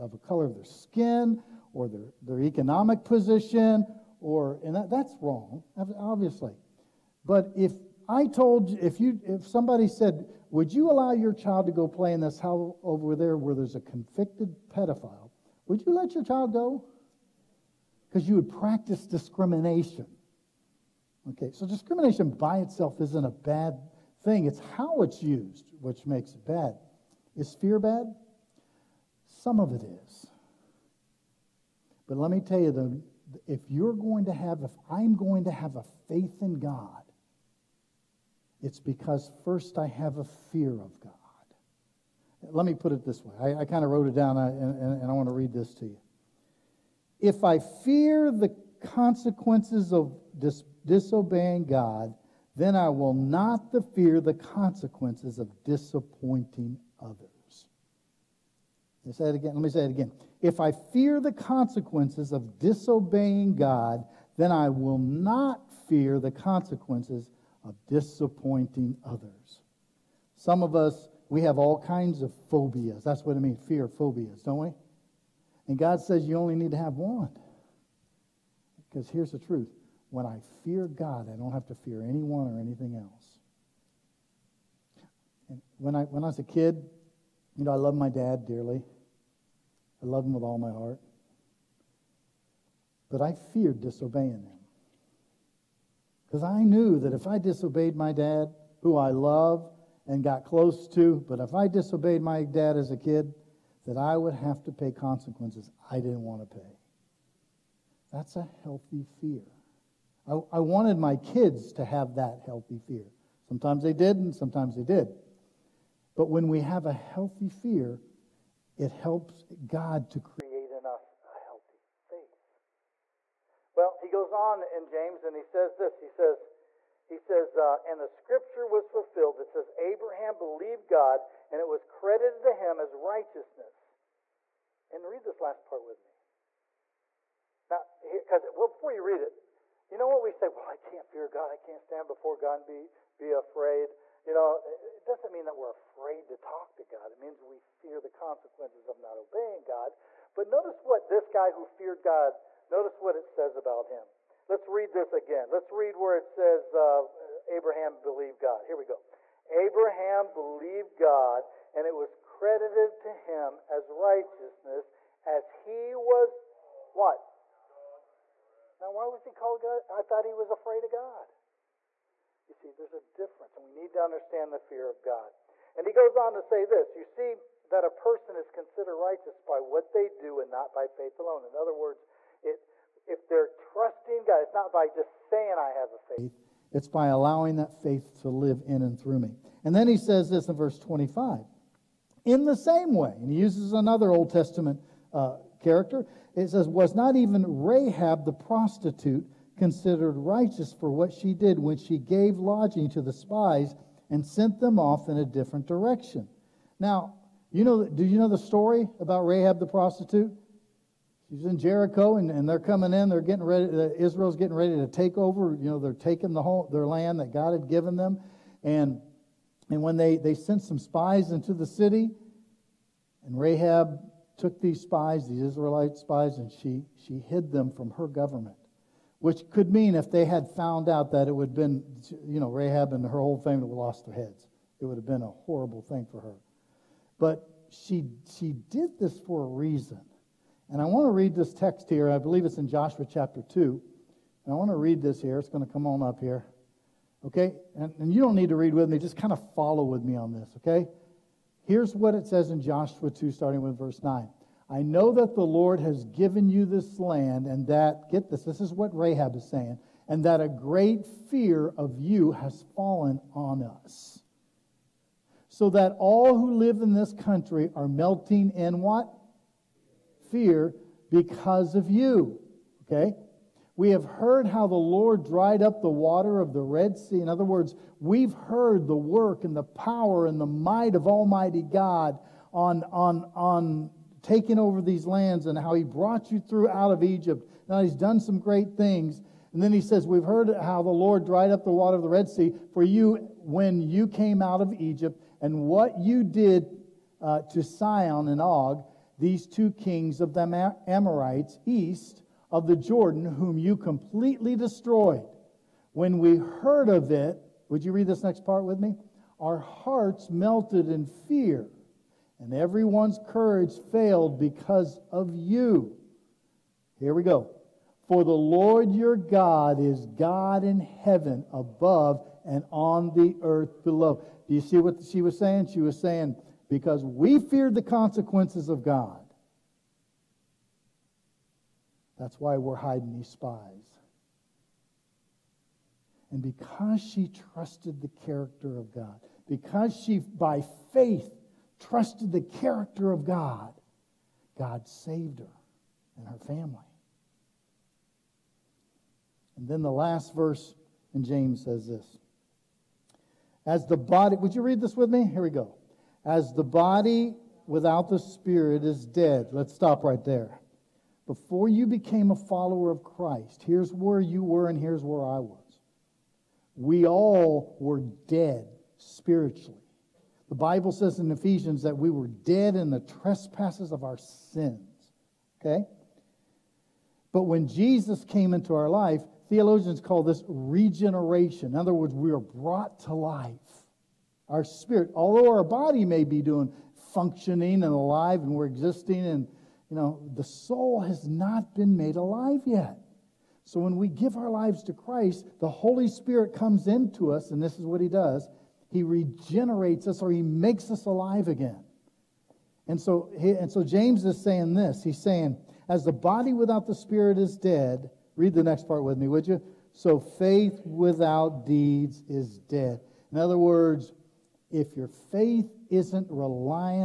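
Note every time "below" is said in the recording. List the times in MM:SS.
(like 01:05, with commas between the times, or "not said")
05:23.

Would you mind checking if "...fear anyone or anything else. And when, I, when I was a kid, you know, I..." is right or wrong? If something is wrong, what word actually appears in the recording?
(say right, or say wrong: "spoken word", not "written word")
right.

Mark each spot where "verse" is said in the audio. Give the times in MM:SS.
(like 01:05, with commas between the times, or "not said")
03:10, 04:13, 05:50.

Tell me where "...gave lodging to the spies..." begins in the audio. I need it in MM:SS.
03:21.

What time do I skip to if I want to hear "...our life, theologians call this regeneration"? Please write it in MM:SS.
06:18.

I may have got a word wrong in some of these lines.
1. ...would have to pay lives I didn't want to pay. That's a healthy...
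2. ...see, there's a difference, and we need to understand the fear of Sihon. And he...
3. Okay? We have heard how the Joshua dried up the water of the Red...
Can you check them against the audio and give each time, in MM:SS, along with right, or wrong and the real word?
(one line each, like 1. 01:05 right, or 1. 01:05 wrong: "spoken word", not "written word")
1. 01:44 wrong: "consequences", not "lives"
2. 02:52 wrong: "God", not "Sihon"
3. 04:32 wrong: "Lord", not "Joshua".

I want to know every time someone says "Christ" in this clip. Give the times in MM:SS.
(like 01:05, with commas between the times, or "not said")
06:03, 06:34.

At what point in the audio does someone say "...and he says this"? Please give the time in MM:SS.
02:05.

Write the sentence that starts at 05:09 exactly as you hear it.
Our hearts melted in fear, and everyone's courage failed because of you.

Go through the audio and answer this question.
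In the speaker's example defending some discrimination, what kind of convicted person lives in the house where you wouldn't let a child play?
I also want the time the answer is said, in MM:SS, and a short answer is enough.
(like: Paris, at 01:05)
Pedophile, at 00:14.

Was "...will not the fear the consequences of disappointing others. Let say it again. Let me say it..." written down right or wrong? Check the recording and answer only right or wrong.
right.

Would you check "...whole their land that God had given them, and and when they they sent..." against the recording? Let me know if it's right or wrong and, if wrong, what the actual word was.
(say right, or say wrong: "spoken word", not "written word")
right.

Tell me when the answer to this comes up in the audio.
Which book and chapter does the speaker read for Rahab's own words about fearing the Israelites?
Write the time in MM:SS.
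04:02.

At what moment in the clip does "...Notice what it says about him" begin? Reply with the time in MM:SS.
02:32.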